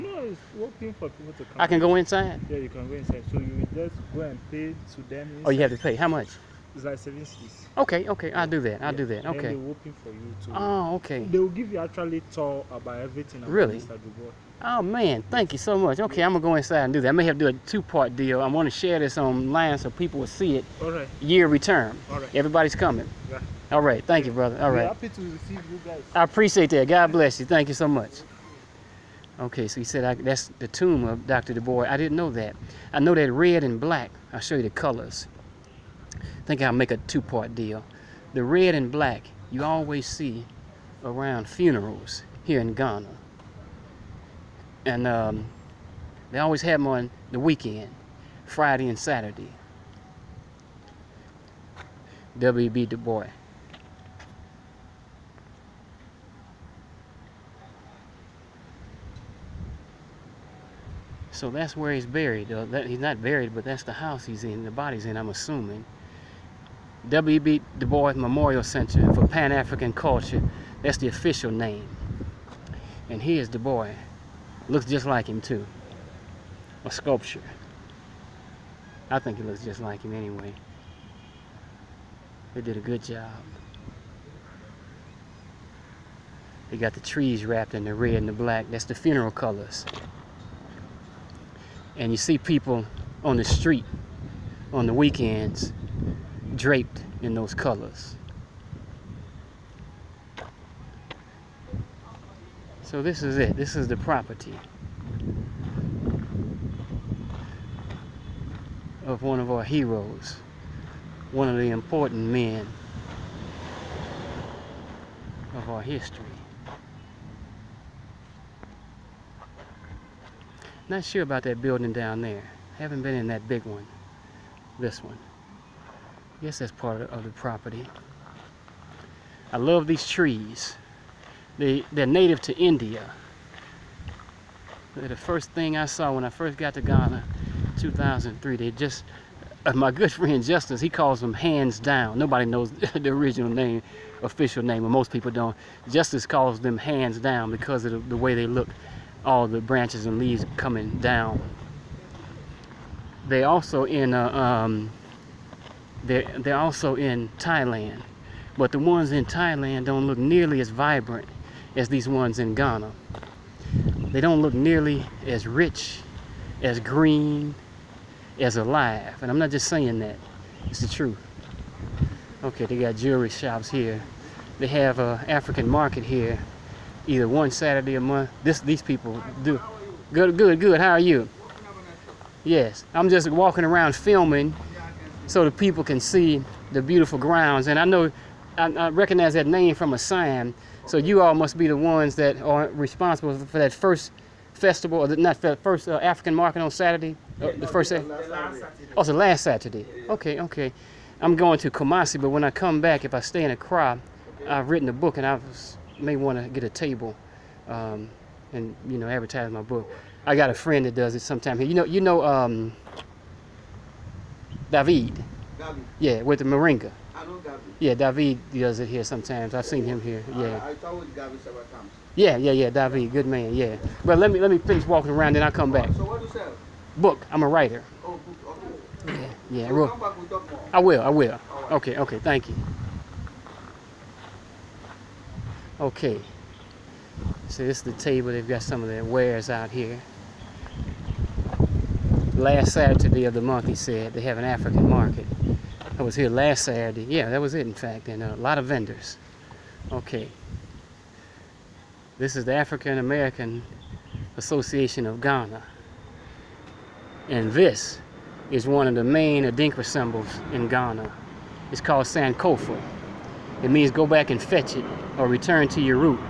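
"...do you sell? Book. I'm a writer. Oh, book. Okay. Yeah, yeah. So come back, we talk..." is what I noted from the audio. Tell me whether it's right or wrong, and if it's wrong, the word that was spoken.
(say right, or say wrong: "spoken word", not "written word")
right.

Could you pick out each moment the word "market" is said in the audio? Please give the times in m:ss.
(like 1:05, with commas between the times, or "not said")
2:55, 3:16, 4:04.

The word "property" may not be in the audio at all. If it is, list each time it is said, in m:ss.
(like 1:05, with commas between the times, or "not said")
1:43, 2:07.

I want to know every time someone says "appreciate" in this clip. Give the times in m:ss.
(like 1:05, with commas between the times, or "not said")
0:26.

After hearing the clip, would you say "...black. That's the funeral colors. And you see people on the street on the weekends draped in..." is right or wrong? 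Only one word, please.
right.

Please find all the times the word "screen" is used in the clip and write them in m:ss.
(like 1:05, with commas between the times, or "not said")
not said.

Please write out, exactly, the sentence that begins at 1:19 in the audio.
I think it looks just like him anyway.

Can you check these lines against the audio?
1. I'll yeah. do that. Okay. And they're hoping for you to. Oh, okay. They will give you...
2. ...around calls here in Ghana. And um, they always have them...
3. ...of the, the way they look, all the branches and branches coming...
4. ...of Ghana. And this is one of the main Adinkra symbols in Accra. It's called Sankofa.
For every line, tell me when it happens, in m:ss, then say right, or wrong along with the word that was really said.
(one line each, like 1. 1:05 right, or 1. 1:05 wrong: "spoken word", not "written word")
1. 0:08 right
2. 0:41 wrong: "funerals", not "calls"
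3. 2:27 wrong: "leaves", not "branches"
4. 4:15 wrong: "Ghana", not "Accra".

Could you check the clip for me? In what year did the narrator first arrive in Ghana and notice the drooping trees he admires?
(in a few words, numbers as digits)
2003.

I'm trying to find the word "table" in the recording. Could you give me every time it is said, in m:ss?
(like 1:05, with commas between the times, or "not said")
3:26, 3:57.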